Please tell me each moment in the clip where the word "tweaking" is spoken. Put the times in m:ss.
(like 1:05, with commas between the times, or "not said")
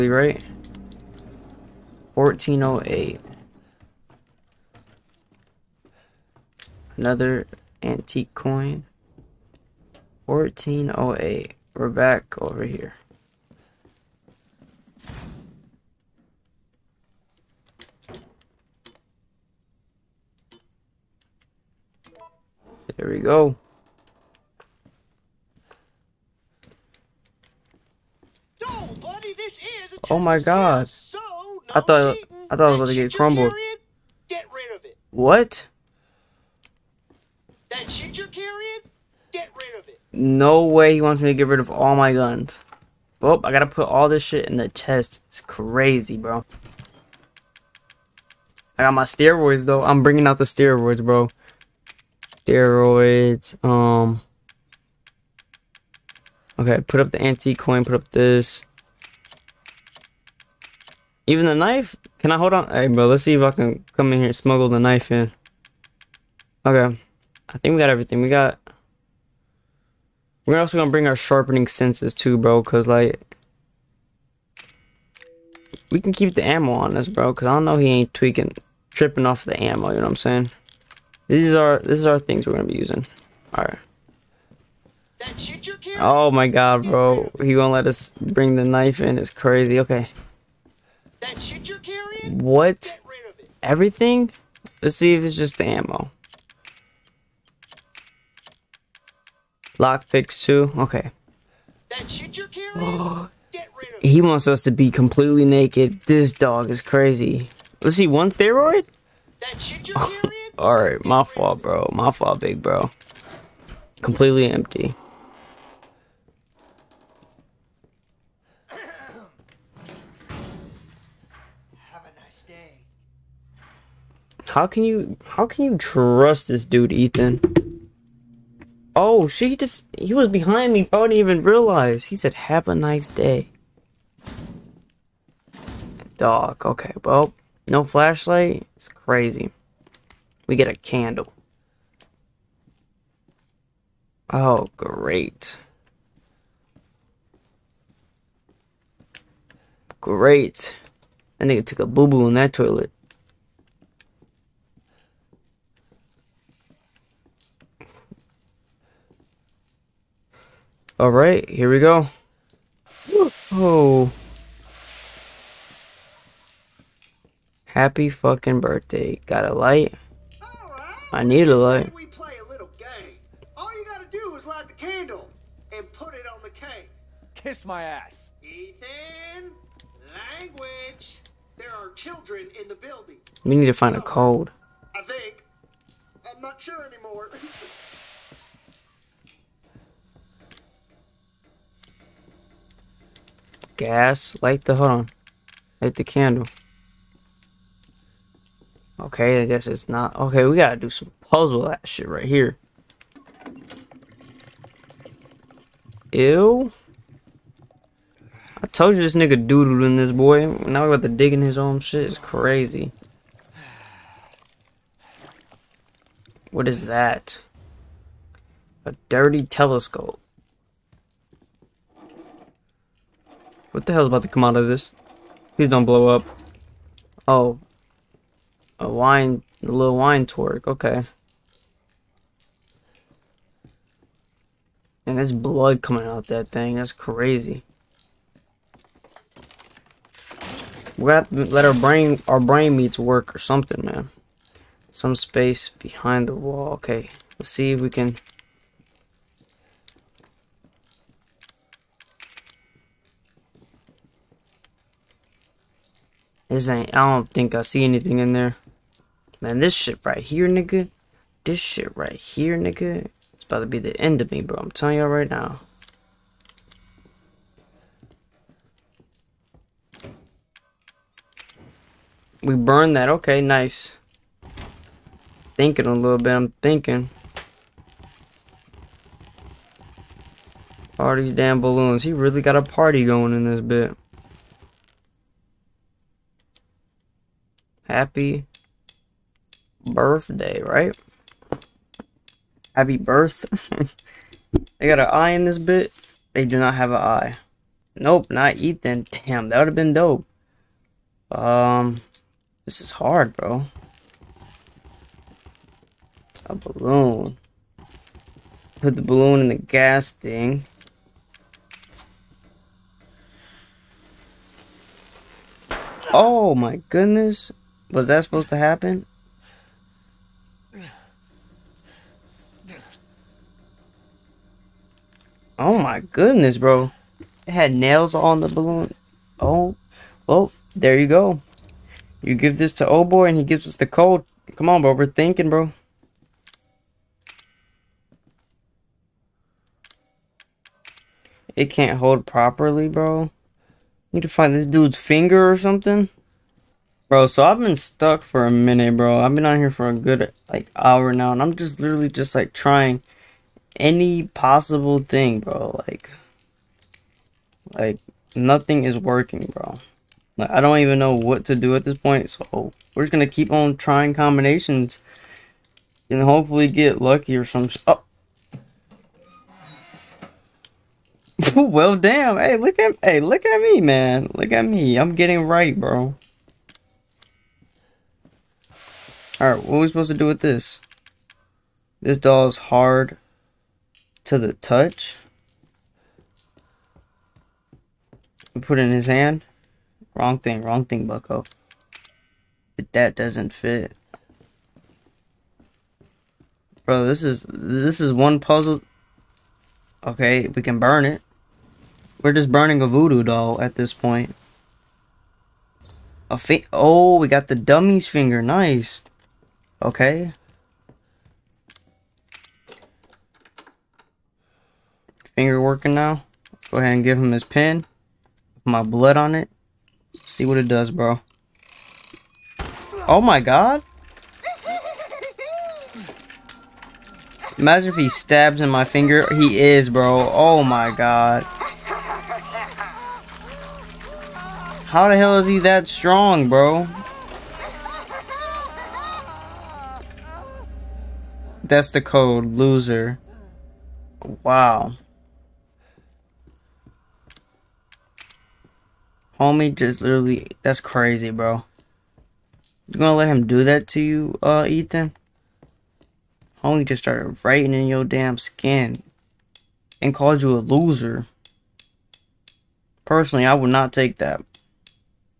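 1:18.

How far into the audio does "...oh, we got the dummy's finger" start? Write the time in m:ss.
6:46.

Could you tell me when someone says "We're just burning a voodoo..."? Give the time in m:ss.
6:42.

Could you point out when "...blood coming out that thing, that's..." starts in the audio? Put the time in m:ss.
3:55.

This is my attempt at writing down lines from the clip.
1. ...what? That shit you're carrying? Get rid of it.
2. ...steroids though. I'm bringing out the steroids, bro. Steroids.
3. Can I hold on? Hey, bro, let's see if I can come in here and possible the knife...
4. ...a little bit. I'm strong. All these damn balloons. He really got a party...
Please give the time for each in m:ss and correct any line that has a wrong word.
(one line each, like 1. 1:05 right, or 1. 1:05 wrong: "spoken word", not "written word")
1. 0:35 right
2. 0:49 right
3. 1:02 wrong: "smuggle", not "possible"
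4. 4:35 wrong: "thinking", not "strong".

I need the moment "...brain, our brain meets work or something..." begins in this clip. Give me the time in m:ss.
4:01.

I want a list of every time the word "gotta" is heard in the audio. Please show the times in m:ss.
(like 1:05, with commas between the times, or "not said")
0:43, 2:53, 3:20.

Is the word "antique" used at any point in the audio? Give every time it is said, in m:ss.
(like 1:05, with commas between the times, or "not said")
0:07, 0:57.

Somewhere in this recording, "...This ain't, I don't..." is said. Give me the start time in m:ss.
4:16.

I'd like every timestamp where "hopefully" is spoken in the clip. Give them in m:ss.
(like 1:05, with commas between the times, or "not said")
6:06.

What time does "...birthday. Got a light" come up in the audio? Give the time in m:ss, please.
2:48.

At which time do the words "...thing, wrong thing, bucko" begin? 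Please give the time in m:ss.
6:30.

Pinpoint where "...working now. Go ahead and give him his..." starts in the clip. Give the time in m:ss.
6:55.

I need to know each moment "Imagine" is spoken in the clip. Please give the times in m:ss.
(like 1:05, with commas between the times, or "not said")
7:07.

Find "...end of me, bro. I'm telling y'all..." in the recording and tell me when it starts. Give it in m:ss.
4:23.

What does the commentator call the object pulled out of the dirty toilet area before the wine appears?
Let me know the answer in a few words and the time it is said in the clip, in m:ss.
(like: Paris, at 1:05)
A dirty telescope, at 3:38.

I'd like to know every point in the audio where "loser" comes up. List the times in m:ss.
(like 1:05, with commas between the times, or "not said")
7:22, 7:40.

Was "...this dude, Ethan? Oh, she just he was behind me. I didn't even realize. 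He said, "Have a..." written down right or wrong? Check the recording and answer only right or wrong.
right.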